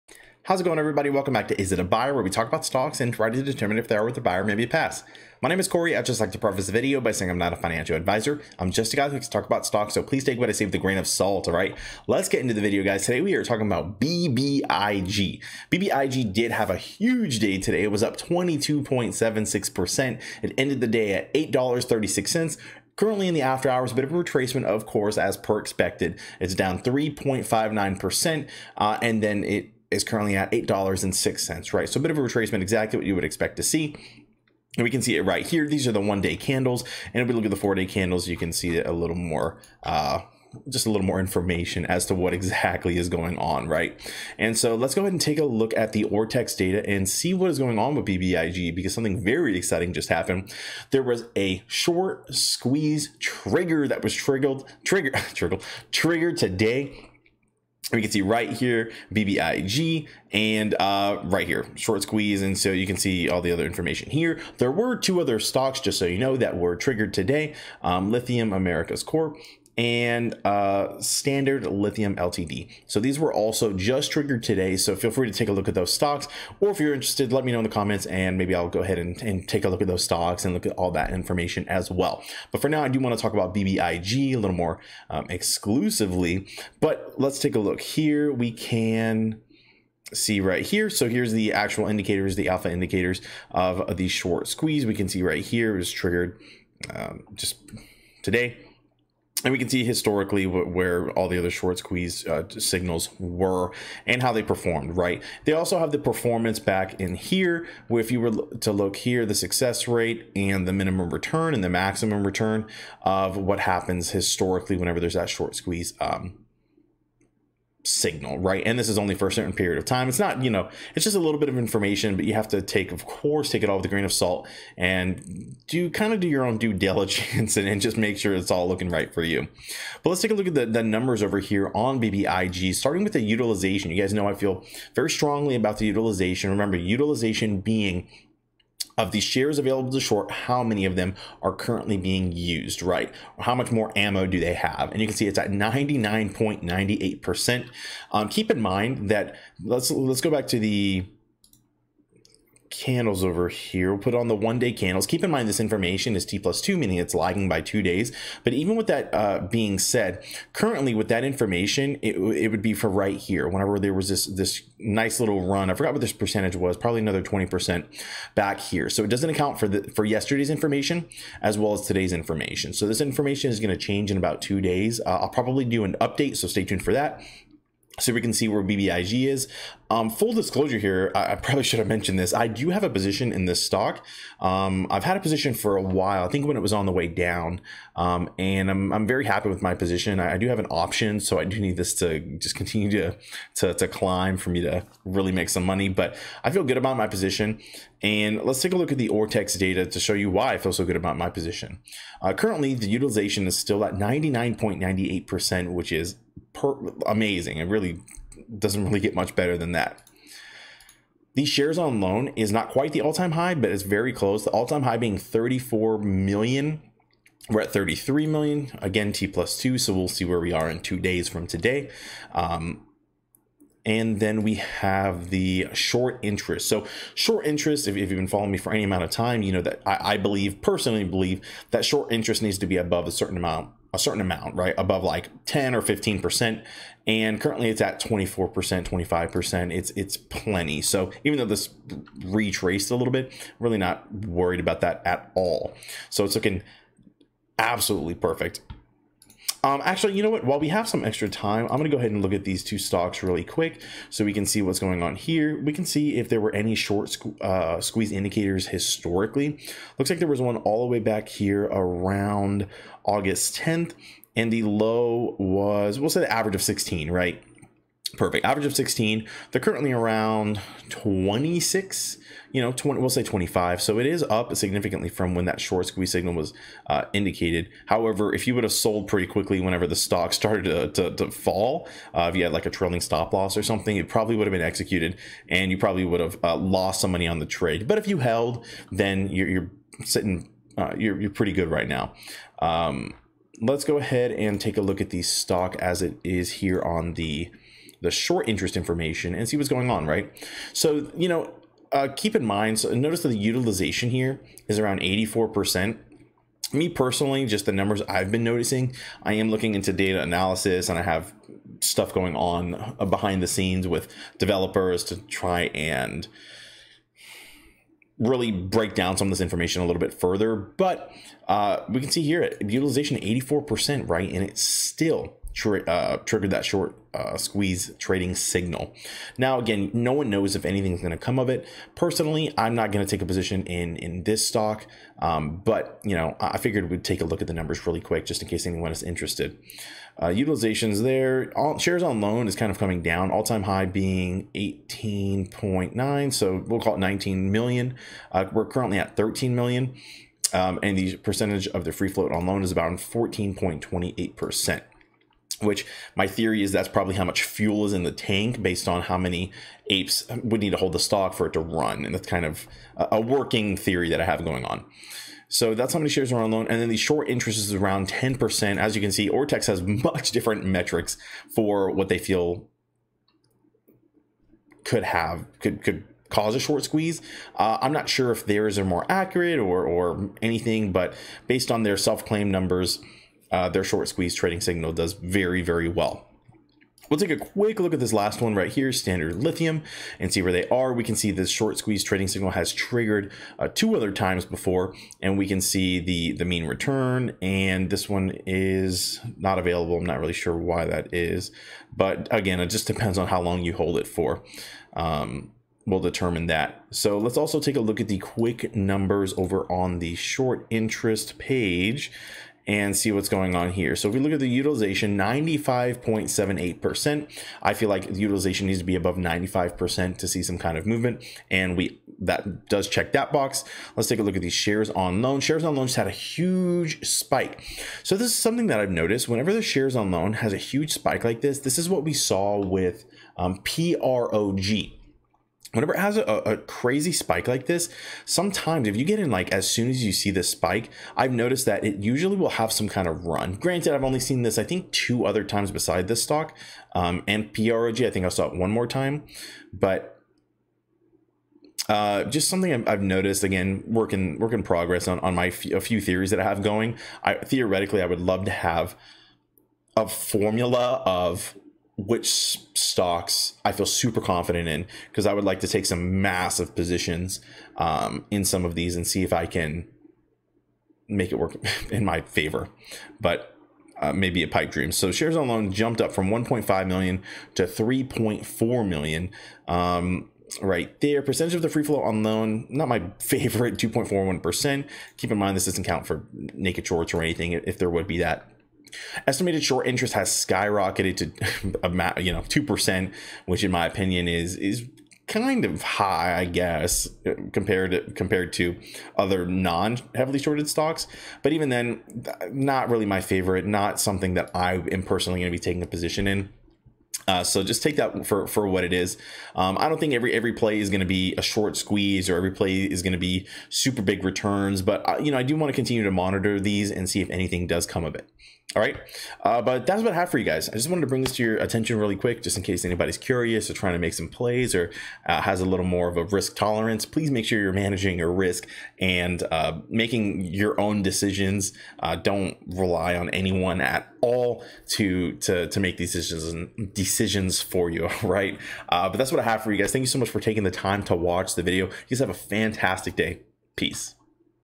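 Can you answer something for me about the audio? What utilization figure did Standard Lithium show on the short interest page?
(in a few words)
95.78%.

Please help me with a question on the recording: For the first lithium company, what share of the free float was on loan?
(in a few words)
14.28%.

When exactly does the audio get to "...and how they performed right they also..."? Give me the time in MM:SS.
01:44.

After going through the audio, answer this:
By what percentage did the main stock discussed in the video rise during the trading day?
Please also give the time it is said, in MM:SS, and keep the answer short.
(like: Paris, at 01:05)
22.76%, at 00:18.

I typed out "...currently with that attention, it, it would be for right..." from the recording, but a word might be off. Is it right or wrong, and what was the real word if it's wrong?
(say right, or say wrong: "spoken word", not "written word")
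wrong: "information", not "attention".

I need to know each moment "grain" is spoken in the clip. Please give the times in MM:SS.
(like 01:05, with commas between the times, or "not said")
00:10, 02:03.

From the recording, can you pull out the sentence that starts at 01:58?
And this is only for a certain period of time.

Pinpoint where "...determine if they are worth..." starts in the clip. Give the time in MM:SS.
00:03.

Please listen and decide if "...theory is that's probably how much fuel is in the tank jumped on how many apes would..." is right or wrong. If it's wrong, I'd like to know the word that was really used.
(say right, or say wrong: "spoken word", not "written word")
wrong: "based", not "jumped".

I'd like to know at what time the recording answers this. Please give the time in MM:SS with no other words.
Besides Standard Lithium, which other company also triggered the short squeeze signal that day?
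01:08.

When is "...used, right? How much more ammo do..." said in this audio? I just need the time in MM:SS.
02:22.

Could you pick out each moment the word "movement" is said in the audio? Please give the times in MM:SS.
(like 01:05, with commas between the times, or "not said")
07:00.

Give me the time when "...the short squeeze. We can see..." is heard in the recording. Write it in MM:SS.
01:33.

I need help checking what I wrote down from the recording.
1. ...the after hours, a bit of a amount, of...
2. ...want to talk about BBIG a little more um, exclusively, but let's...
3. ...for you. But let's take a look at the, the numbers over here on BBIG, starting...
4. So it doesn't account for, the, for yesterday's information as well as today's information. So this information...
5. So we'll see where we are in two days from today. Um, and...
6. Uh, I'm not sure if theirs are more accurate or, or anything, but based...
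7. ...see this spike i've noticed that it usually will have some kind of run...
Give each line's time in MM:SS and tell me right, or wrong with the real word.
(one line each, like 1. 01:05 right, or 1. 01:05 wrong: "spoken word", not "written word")
1. 00:23 wrong: "retracement", not "amount"
2. 01:22 right
3. 02:09 right
4. 02:48 right
5. 03:39 right
6. 06:17 right
7. 07:20 right.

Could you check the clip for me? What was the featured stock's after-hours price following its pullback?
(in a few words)
$8.06.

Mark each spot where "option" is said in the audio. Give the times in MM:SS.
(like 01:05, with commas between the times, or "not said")
03:10.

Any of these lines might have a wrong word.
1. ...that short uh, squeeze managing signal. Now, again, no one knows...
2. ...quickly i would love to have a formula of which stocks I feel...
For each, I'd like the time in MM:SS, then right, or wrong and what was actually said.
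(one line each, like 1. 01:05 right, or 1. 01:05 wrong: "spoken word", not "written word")
1. 05:26 wrong: "trading", not "managing"
2. 07:37 wrong: "theoretically", not "quickly".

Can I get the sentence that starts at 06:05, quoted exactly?
So that's how many shares are on loan.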